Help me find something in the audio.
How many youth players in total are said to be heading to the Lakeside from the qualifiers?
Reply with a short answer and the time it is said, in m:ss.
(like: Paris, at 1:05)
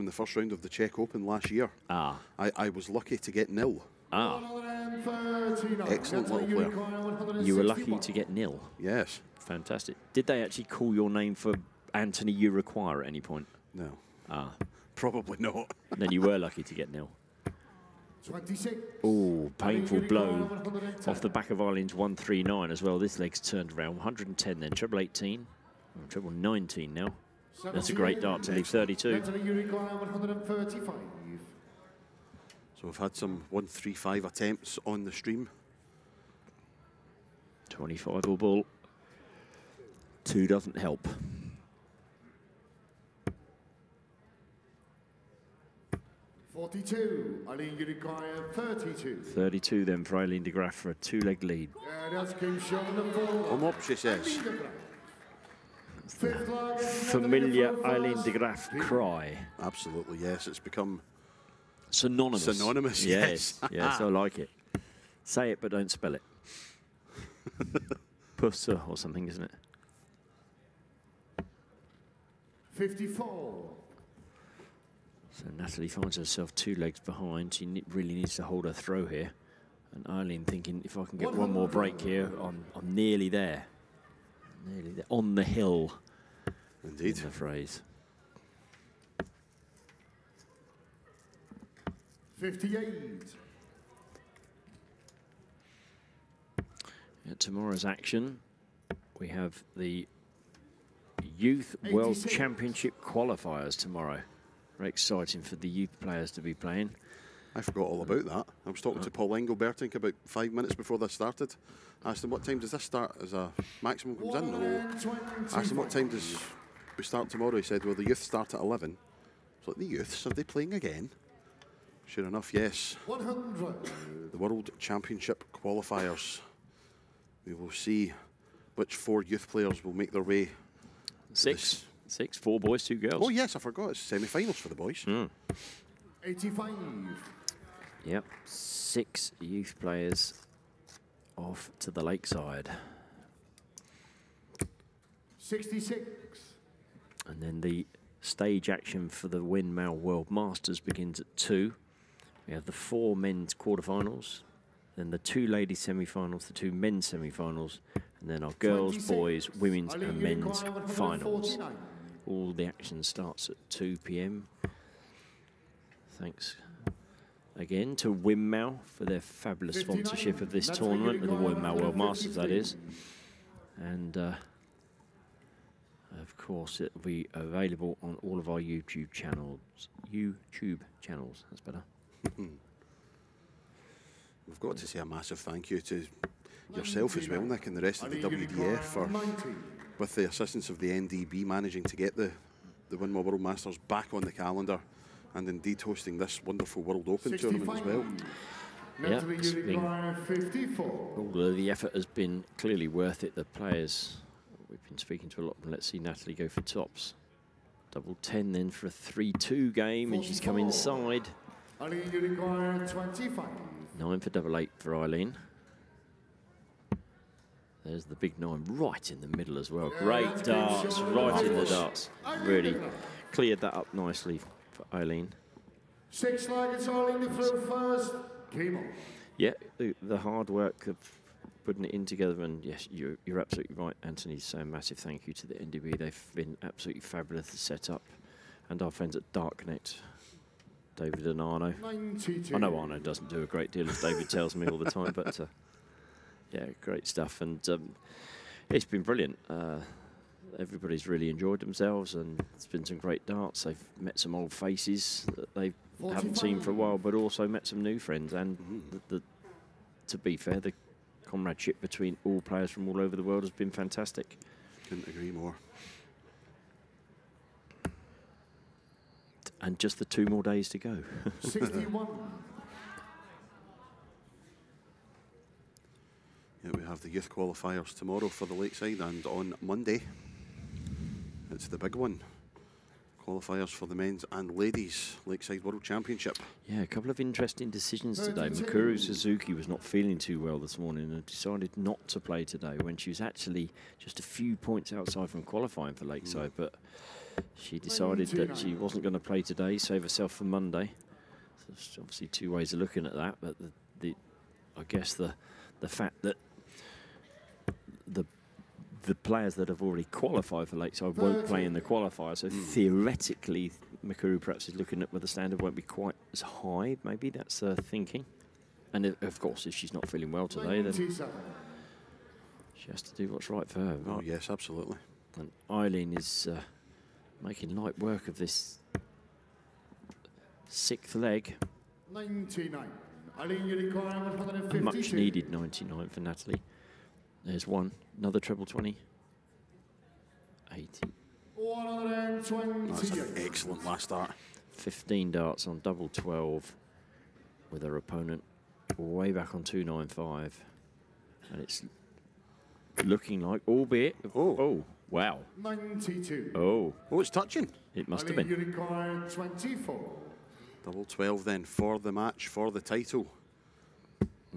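6, at 2:12.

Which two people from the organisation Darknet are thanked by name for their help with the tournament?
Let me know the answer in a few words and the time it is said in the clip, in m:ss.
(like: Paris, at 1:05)
David and Arno, at 4:00.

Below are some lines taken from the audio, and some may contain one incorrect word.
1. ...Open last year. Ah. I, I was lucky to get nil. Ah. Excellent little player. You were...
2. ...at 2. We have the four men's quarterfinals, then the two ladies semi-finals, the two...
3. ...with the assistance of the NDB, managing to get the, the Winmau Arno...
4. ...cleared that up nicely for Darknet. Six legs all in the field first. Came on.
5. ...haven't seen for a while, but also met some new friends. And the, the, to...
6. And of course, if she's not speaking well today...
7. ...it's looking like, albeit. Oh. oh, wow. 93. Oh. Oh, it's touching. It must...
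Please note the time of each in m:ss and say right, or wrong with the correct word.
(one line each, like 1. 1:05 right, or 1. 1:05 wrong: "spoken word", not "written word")
1. 0:00 right
2. 2:31 right
3. 3:09 wrong: "World", not "Arno"
4. 3:43 wrong: "Aileen", not "Darknet"
5. 4:16 right
6. 5:18 wrong: "feeling", not "speaking"
7. 5:51 wrong: "92", not "93".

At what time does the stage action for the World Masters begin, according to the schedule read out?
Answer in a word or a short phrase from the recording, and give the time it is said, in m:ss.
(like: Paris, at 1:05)
2 p.m., at 2:42.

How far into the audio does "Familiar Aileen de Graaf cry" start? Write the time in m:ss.
0:56.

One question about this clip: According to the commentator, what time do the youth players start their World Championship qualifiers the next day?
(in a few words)
11.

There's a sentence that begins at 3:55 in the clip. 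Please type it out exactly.
They've been absolutely fabulous to set up.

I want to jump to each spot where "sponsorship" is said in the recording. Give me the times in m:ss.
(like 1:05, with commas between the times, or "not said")
2:49.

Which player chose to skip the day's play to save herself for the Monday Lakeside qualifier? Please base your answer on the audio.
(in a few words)
Mikuru Suzuki.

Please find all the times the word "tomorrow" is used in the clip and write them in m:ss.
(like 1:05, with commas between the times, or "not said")
1:37, 1:43, 1:57, 4:37.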